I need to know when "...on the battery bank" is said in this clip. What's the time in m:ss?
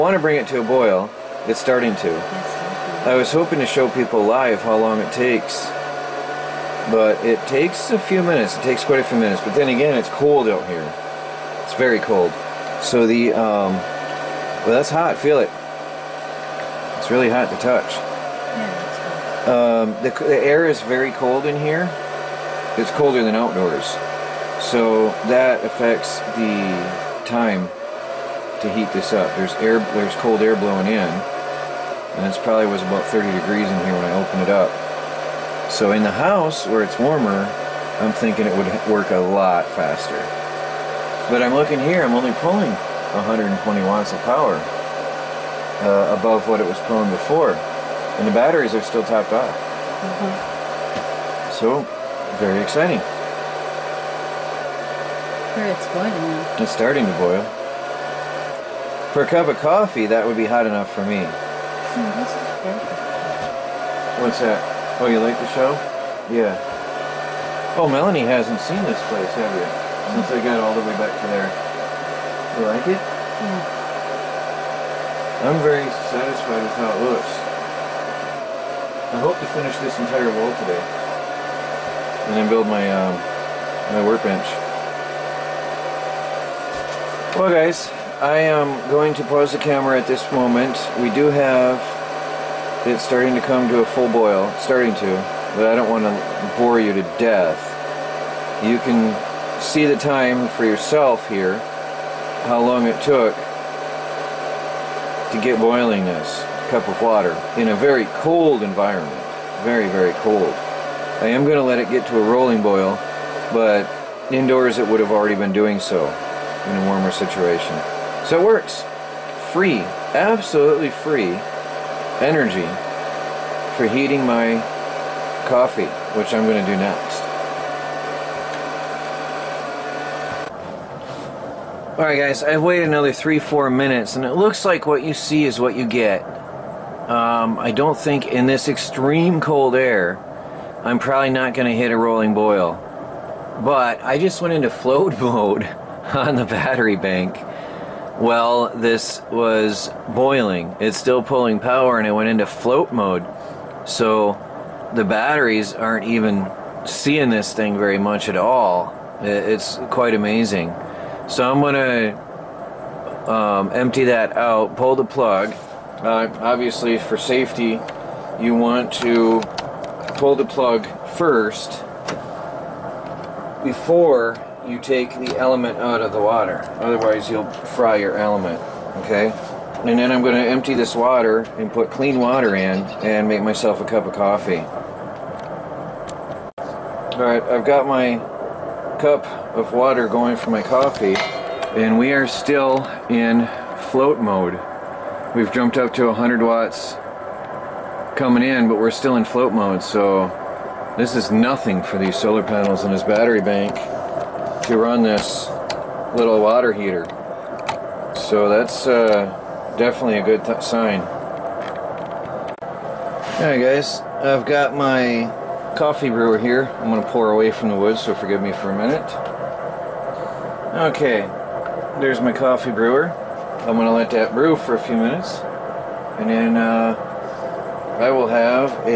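2:25.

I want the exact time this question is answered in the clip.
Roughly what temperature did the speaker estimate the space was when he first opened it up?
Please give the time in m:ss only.
0:33.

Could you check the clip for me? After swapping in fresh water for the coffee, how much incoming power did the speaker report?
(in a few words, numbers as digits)
100 watts.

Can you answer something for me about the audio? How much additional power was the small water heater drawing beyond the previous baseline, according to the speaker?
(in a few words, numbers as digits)
120 watts.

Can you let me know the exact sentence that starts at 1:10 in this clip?
Since I got all the way back to there.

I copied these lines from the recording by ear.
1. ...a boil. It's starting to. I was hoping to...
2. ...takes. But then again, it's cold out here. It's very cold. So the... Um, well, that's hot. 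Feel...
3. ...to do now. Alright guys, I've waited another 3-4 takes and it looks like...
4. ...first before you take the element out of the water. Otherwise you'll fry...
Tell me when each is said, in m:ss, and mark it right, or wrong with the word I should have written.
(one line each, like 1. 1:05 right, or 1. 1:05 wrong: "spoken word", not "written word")
1. 0:00 right
2. 0:09 wrong: "minutes", not "takes"
3. 2:06 wrong: "minutes", not "takes"
4. 2:51 right.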